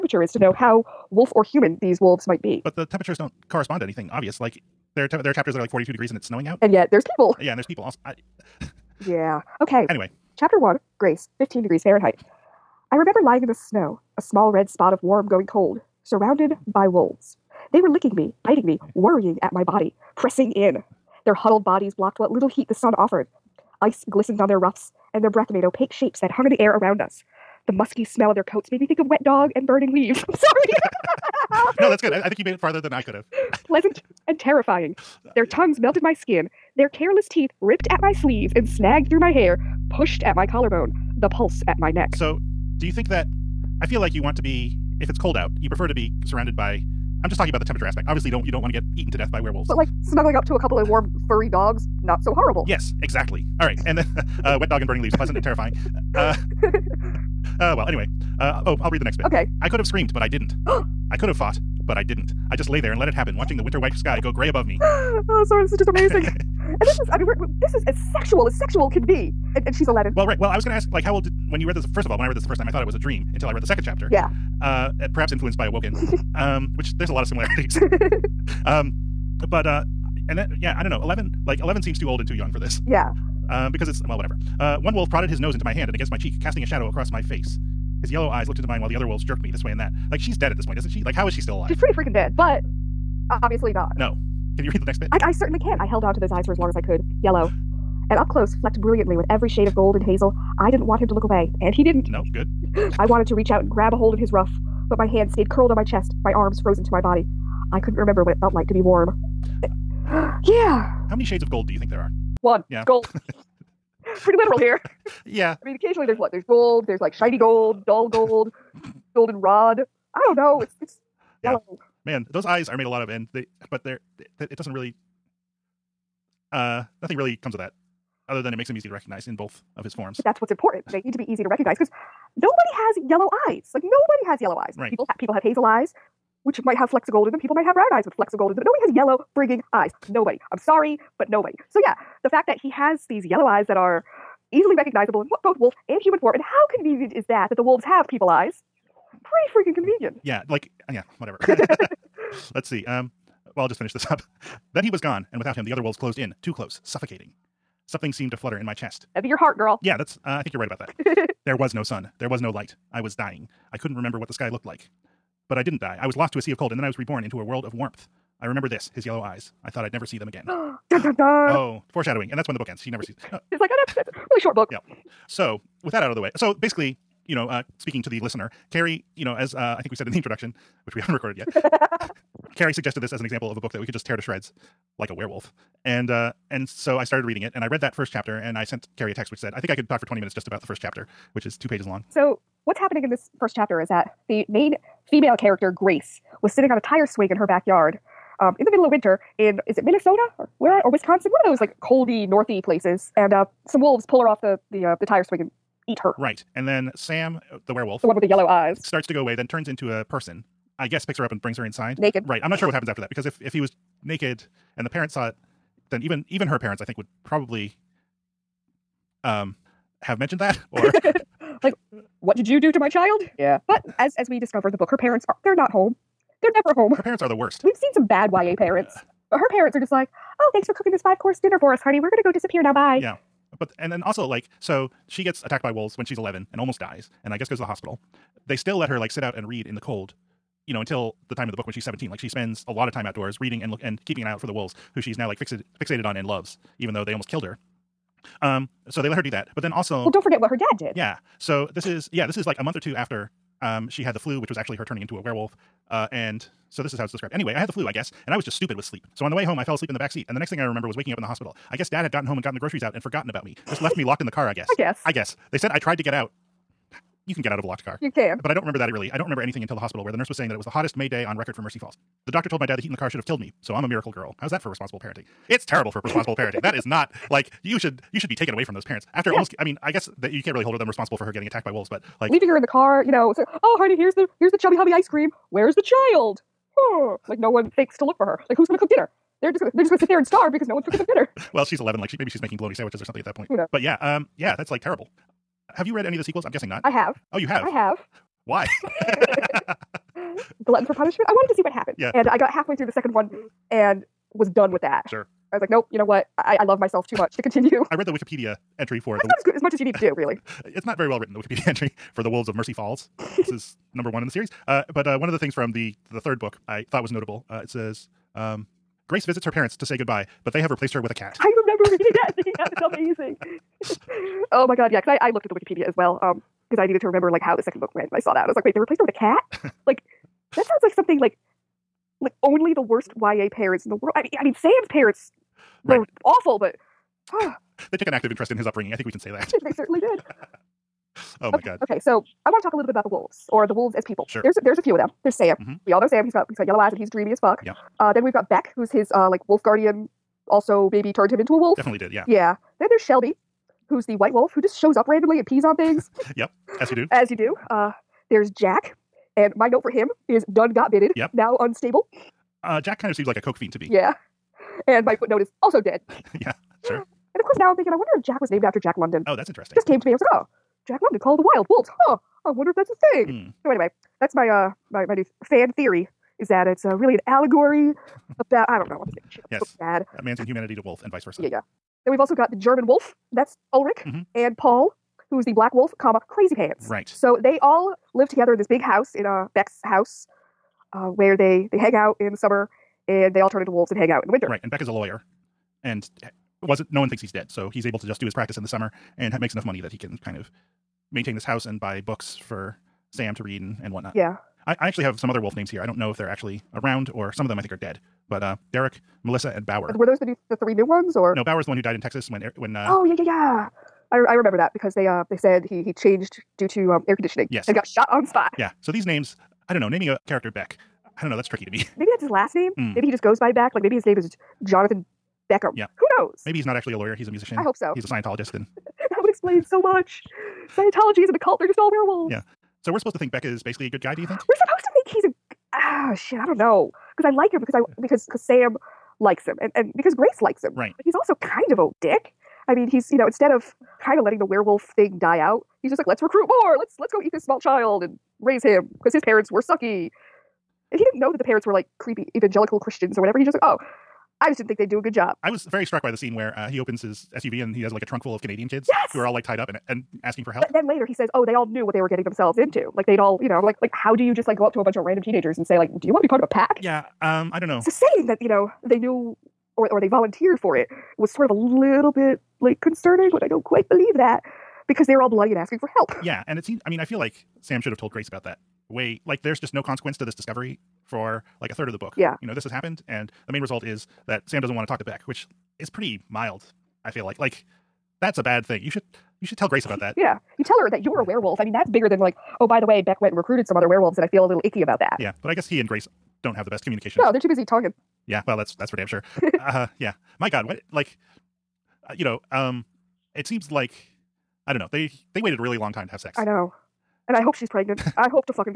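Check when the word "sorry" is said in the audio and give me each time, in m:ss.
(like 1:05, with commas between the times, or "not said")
0:30, 1:05, 2:20.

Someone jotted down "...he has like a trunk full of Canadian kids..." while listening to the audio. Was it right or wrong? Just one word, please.
right.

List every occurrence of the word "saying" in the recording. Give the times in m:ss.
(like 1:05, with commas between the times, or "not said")
4:30, 7:47.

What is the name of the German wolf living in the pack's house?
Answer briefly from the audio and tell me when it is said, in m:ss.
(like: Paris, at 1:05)
Ulrich, at 6:23.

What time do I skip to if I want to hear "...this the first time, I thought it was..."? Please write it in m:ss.
1:12.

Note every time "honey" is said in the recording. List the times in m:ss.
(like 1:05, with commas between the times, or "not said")
3:51, 4:43.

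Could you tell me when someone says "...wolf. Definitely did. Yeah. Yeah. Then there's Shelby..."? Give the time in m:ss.
5:51.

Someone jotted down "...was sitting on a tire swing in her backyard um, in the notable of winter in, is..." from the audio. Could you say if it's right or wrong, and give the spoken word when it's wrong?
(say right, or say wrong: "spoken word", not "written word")
wrong: "middle", not "notable".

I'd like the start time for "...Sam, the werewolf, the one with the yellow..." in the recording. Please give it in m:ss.
3:26.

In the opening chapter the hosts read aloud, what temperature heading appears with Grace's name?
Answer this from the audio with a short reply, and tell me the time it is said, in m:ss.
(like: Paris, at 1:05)
15 degrees Fahrenheit, at 0:11.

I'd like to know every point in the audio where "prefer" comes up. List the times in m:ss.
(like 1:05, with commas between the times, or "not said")
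0:45.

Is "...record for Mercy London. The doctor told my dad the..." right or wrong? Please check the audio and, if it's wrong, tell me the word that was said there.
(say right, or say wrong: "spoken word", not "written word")
wrong: "Falls", not "London".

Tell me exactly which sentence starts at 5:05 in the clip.
Sure I was like, nope, you know what?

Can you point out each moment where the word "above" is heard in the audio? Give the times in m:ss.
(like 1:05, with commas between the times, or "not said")
1:04.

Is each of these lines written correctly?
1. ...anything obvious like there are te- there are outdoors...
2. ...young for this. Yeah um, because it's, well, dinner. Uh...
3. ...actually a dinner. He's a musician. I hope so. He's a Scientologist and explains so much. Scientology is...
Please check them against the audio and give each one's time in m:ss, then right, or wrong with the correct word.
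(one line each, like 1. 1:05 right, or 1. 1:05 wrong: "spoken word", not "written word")
1. 0:03 wrong: "chapters", not "outdoors"
2. 1:22 wrong: "whatever", not "dinner"
3. 7:06 wrong: "lawyer", not "dinner".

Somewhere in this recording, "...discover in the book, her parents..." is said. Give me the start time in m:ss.
3:44.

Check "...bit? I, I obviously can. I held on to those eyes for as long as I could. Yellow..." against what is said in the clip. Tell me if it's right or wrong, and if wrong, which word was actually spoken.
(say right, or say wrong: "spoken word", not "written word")
wrong: "certainly", not "obviously".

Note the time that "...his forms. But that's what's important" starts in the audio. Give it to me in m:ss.
2:09.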